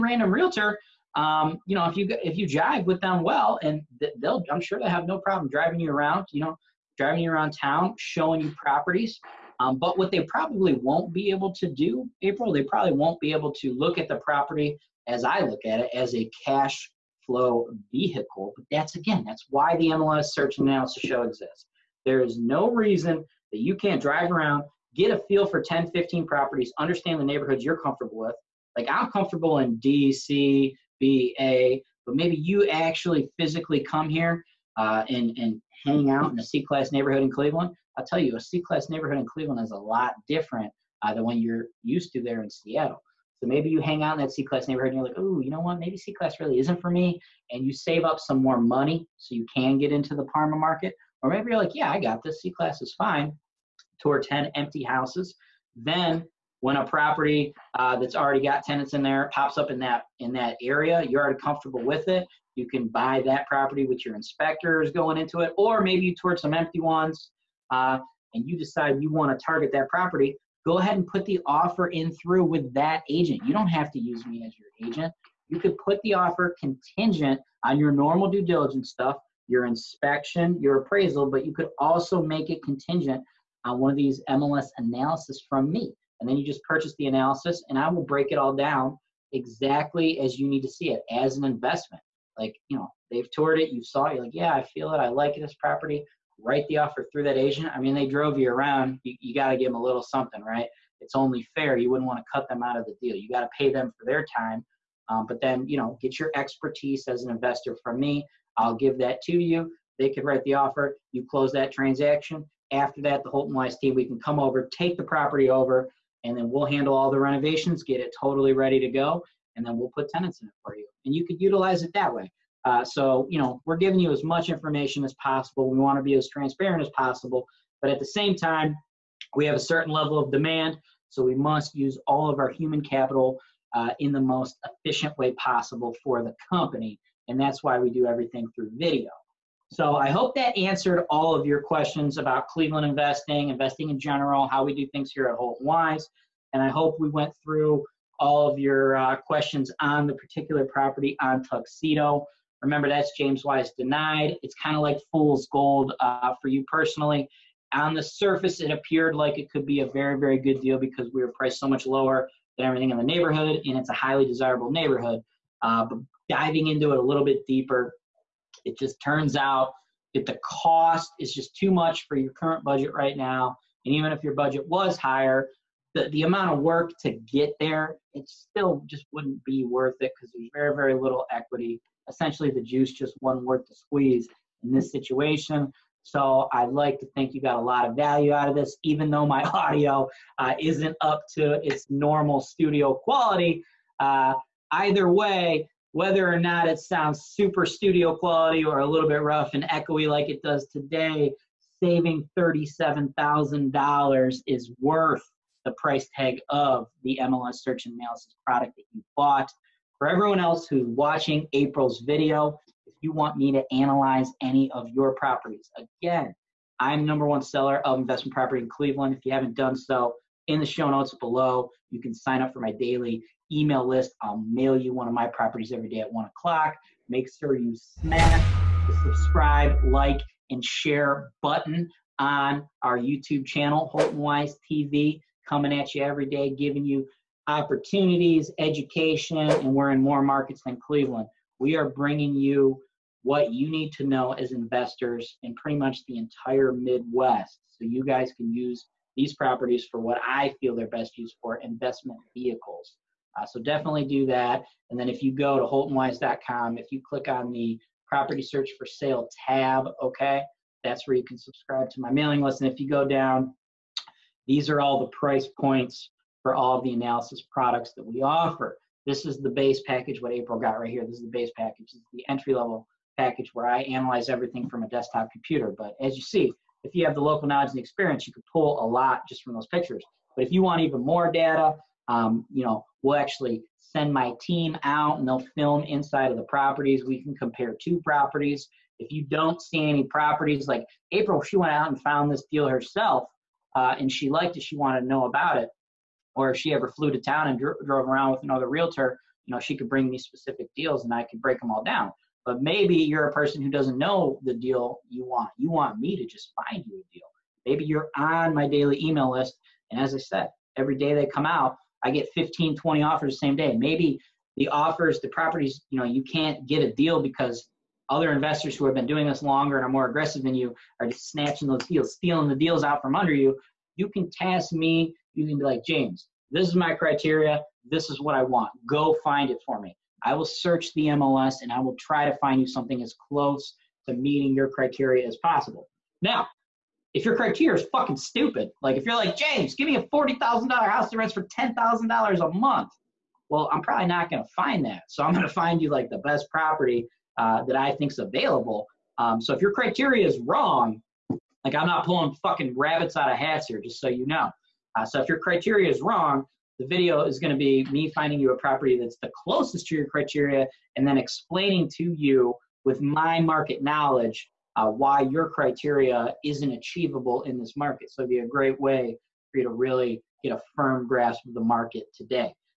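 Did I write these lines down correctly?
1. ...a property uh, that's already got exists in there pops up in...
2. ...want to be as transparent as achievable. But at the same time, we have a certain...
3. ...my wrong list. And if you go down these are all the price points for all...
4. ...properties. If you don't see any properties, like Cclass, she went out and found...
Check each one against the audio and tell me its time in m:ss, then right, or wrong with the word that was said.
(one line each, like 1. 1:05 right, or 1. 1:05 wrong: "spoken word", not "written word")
1. 0:56 wrong: "tenants", not "exists"
2. 2:05 wrong: "possible", not "achievable"
3. 4:22 wrong: "mailing", not "wrong"
4. 4:48 wrong: "April", not "Cclass".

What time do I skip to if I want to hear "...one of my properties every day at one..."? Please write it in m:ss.
3:44.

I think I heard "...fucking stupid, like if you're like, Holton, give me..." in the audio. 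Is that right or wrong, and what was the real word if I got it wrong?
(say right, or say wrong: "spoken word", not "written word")
wrong: "James", not "Holton".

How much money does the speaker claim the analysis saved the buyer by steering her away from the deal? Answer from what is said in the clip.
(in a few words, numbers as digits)
$37,000.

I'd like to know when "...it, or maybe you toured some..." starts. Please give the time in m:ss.
1:05.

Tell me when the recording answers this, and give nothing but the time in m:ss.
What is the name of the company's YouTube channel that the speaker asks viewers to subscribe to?
3:53.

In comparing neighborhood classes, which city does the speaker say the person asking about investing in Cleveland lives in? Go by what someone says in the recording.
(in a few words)
Seattle.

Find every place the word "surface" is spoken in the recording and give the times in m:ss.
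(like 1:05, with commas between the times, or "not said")
2:38.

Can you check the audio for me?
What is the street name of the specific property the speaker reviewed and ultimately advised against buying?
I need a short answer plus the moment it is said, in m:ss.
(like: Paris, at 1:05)
Tuxedo, at 2:31.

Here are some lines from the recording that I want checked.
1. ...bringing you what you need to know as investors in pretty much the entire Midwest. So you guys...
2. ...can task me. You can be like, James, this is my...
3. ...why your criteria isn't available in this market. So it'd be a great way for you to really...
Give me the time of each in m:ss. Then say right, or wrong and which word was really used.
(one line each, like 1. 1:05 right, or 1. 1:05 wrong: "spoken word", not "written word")
1. 4:01 right
2. 5:24 right
3. 6:04 wrong: "achievable", not "available".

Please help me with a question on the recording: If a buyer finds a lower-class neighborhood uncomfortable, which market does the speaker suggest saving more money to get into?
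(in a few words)
Parma.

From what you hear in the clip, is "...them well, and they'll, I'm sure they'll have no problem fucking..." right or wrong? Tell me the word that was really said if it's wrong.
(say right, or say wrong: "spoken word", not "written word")
wrong: "driving", not "fucking".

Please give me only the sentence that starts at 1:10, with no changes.
Go ahead and put the offer in through with that agent.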